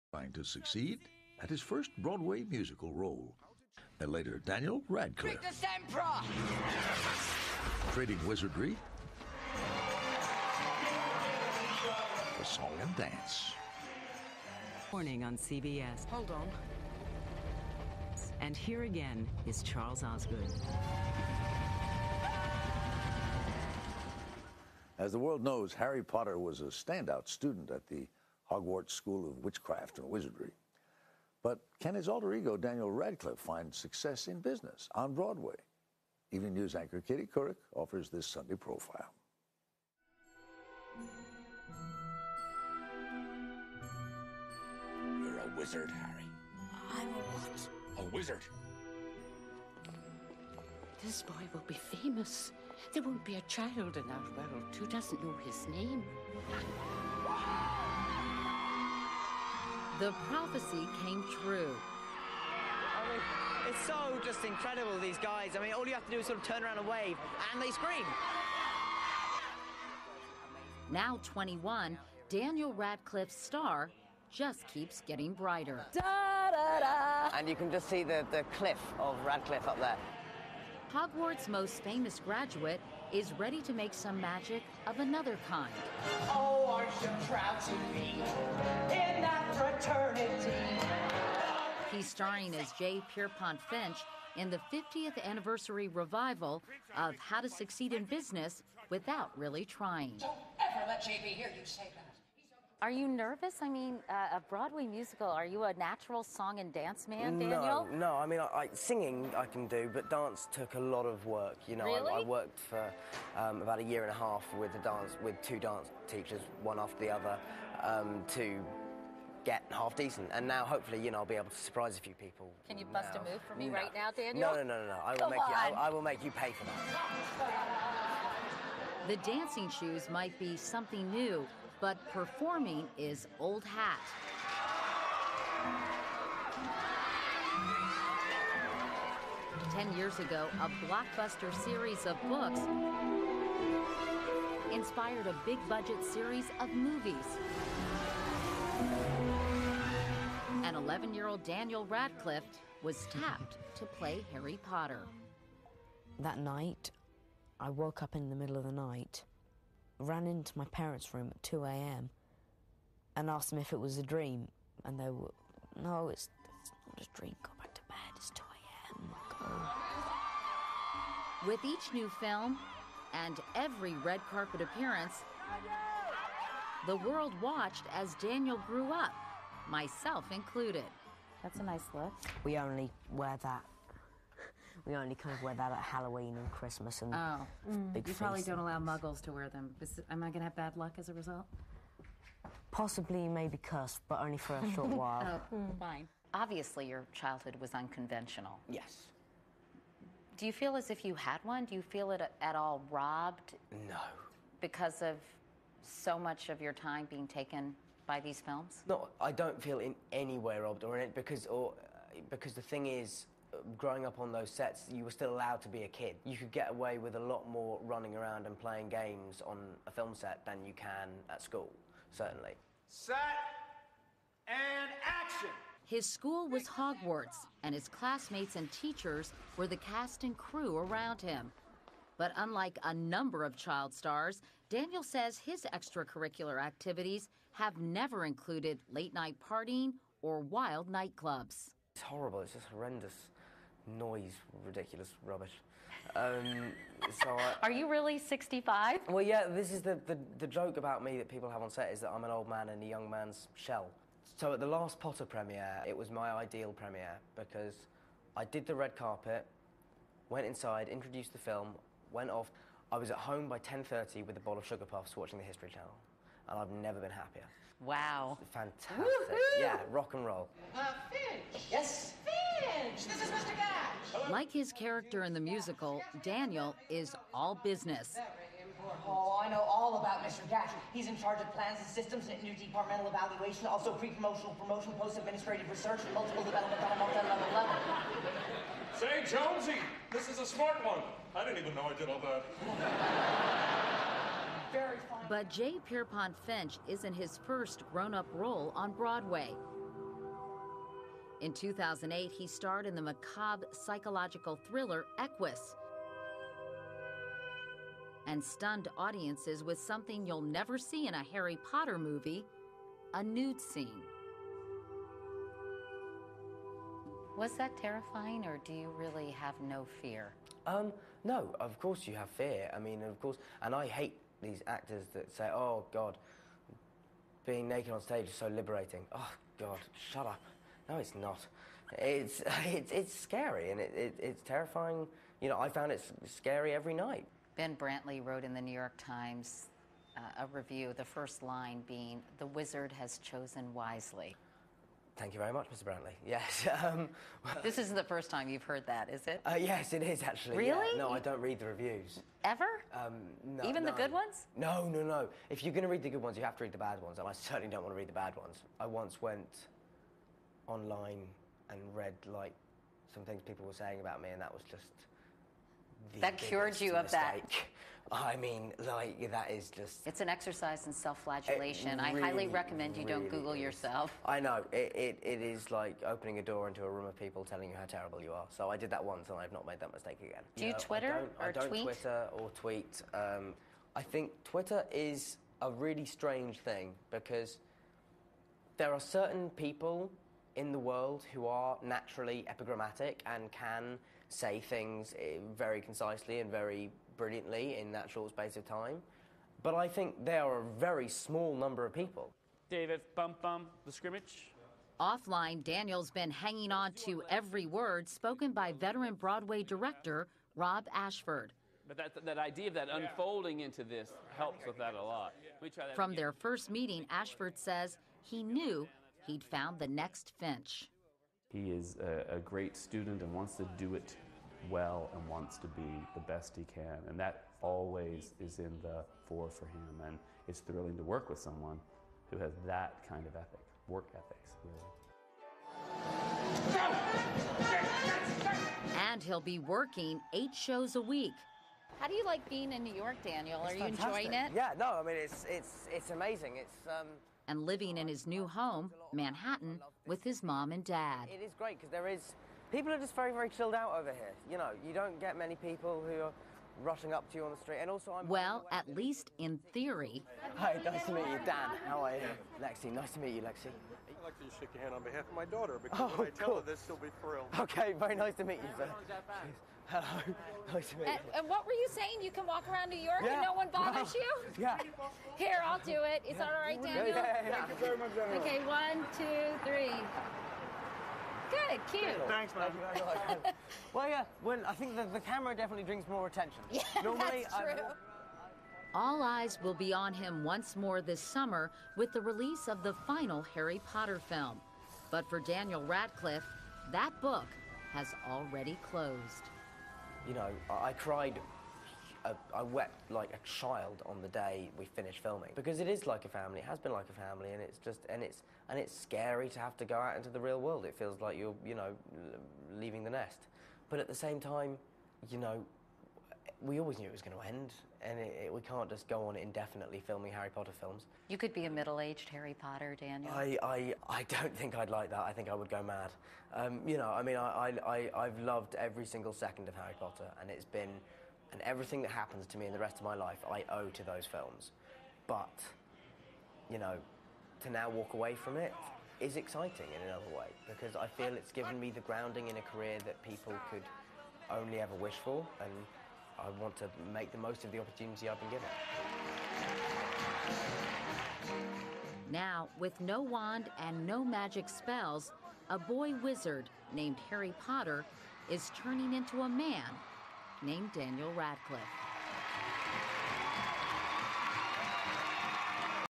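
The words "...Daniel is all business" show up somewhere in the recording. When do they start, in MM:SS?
04:36.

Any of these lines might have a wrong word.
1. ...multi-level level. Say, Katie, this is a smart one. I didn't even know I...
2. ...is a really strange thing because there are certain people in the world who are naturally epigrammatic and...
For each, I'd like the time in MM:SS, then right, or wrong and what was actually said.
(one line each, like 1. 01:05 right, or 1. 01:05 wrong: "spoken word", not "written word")
1. 04:46 wrong: "Jonesy", not "Katie"
2. 06:24 right.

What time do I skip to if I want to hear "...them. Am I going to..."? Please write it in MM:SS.
03:09.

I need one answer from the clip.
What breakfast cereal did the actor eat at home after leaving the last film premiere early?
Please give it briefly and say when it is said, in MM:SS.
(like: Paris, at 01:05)
Sugar Puffs, at 04:24.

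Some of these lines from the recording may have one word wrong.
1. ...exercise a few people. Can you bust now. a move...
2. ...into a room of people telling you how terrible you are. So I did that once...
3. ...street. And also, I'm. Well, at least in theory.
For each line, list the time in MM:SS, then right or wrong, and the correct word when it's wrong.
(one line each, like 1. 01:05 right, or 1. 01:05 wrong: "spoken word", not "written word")
1. 02:01 wrong: "surprise", not "exercise"
2. 06:16 right
3. 07:37 right.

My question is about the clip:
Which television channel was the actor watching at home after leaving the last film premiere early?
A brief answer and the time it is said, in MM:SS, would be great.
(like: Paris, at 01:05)
History Channel, at 04:25.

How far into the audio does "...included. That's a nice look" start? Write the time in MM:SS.
03:00.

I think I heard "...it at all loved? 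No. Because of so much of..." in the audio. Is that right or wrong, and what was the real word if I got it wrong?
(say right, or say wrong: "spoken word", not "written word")
wrong: "robbed", not "loved".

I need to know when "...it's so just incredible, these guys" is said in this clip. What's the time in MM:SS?
01:03.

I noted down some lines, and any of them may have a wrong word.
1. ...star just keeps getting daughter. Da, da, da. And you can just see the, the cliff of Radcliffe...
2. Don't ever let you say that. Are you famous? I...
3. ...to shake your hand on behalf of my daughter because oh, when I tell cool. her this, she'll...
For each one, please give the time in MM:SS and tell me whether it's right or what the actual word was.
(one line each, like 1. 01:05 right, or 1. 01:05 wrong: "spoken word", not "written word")
1. 01:13 wrong: "brighter", not "daughter"
2. 01:40 wrong: "nervous", not "famous"
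3. 07:44 right.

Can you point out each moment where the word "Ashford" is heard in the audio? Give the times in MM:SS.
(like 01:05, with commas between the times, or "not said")
06:50, 06:57.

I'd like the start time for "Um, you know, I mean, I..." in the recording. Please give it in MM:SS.
08:46.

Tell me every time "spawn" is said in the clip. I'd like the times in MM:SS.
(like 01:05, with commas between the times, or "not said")
not said.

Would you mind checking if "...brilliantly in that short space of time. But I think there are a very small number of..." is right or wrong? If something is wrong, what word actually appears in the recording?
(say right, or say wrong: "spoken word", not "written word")
right.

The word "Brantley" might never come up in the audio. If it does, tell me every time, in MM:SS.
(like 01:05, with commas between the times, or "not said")
05:37, 05:45.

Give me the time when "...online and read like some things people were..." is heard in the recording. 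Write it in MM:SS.
06:00.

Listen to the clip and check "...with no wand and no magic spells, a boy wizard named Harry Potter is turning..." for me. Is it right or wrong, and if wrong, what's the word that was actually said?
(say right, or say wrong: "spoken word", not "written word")
right.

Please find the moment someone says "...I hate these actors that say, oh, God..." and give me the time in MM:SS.
05:23.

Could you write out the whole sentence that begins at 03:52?
But unlike a number of child stars, Daniel says his extracurricular activities have never included late night partying or wild nightclubs.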